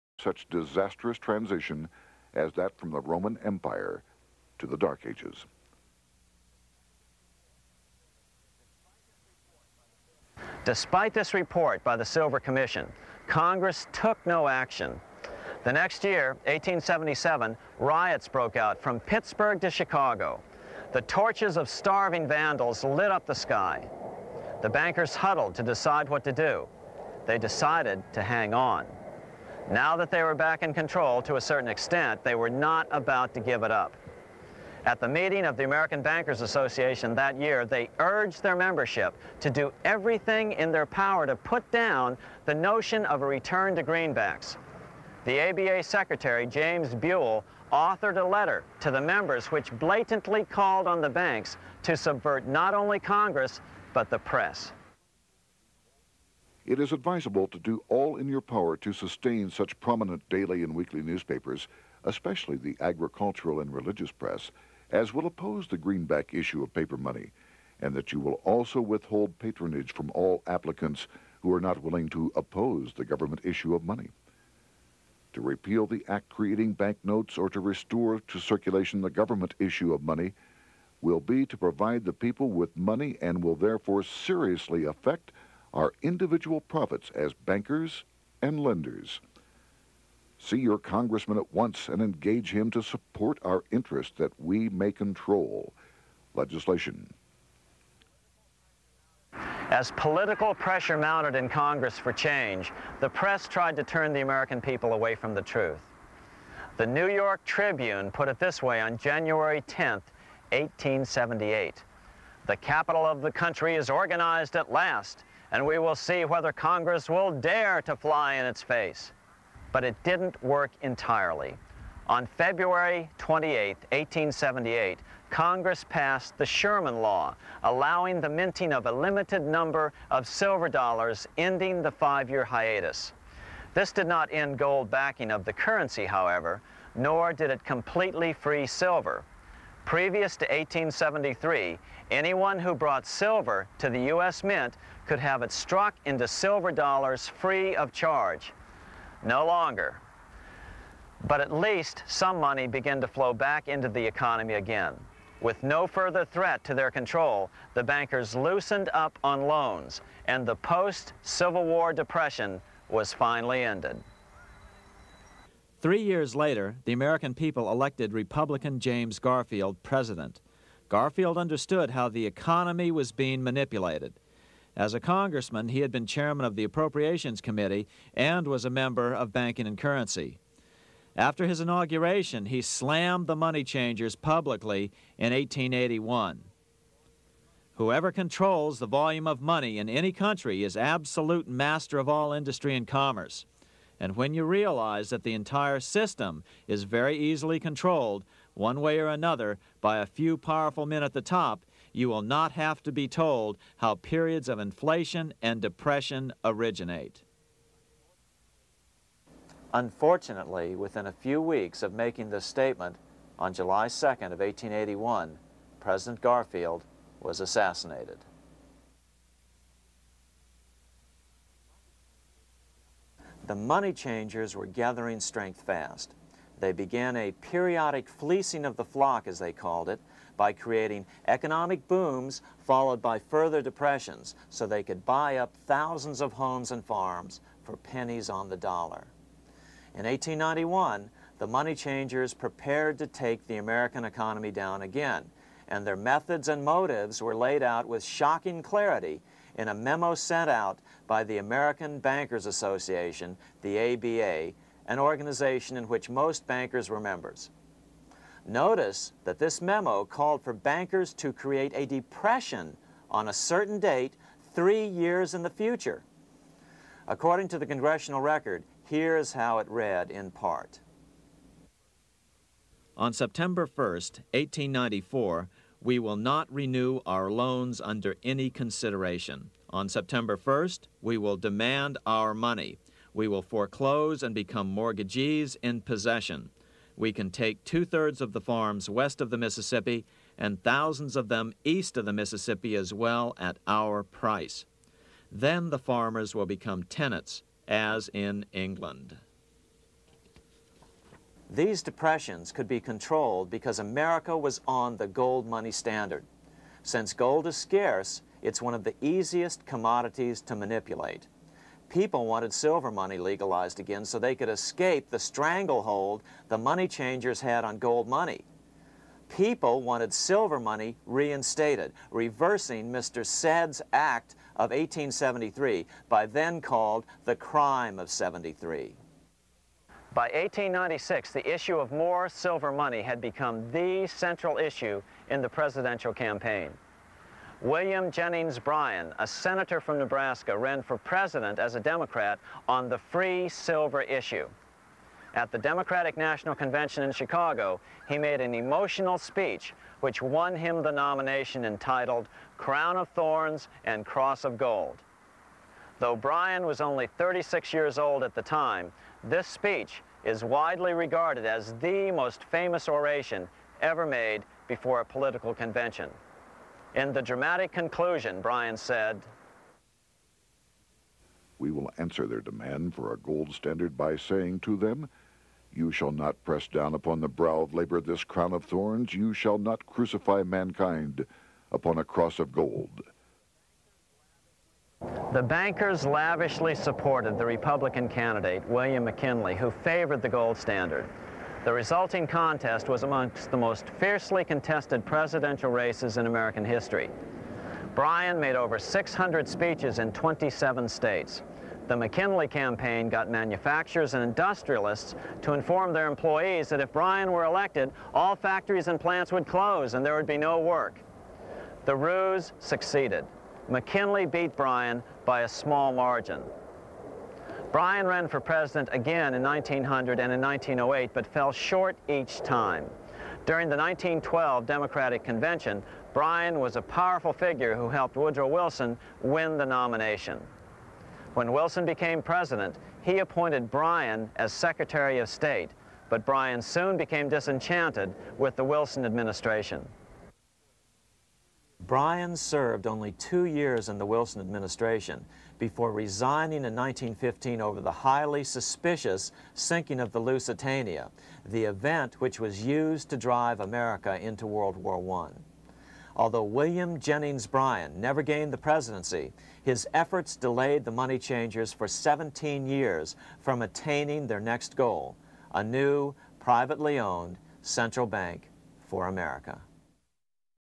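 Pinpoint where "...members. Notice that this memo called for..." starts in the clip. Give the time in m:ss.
4:16.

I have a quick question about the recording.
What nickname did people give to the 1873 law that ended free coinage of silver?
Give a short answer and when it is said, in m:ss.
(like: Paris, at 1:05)
Crime of 73, at 5:27.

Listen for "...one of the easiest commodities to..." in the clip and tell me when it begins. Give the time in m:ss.
5:08.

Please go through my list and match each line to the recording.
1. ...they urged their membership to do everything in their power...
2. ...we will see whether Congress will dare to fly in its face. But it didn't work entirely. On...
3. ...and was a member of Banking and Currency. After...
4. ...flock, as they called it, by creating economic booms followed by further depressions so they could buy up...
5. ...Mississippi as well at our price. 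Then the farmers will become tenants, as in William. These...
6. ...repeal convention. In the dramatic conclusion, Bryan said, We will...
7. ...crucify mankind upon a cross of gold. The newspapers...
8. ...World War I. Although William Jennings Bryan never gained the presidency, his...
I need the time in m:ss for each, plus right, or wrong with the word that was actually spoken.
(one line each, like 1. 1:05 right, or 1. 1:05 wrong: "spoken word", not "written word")
1. 0:37 right
2. 1:55 right
3. 2:58 right
4. 3:48 right
5. 4:52 wrong: "England", not "William"
6. 6:05 wrong: "political", not "repeal"
7. 6:19 wrong: "bankers", not "newspapers"
8. 7:34 right.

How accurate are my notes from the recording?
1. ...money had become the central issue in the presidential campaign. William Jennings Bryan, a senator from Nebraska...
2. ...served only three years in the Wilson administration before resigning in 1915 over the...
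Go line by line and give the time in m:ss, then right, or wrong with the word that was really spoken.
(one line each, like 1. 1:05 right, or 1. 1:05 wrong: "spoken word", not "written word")
1. 5:32 right
2. 7:22 wrong: "two", not "three".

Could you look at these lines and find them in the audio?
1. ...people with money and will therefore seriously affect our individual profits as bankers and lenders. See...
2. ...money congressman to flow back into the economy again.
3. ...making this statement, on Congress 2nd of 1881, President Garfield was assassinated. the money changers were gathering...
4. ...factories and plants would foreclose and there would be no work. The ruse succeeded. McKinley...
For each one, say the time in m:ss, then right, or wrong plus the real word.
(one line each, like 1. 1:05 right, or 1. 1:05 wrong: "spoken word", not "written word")
1. 1:22 right
2. 2:32 wrong: "began", not "congressman"
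3. 3:31 wrong: "July", not "Congress"
4. 6:48 wrong: "close", not "foreclose".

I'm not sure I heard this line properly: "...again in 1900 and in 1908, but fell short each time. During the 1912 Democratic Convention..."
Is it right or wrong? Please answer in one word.
right.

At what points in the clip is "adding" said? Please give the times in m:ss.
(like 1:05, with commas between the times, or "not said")
not said.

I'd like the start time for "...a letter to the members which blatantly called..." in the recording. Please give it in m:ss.
0:48.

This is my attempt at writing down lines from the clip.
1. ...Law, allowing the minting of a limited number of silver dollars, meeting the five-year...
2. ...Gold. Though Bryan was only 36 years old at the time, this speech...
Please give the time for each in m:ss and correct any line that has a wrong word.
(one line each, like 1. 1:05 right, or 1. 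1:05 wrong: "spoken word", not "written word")
1. 2:07 wrong: "ending", not "meeting"
2. 5:54 right.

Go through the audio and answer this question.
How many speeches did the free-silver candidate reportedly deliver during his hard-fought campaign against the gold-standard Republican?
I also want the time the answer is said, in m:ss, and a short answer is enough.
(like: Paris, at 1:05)
over 600, at 6:38.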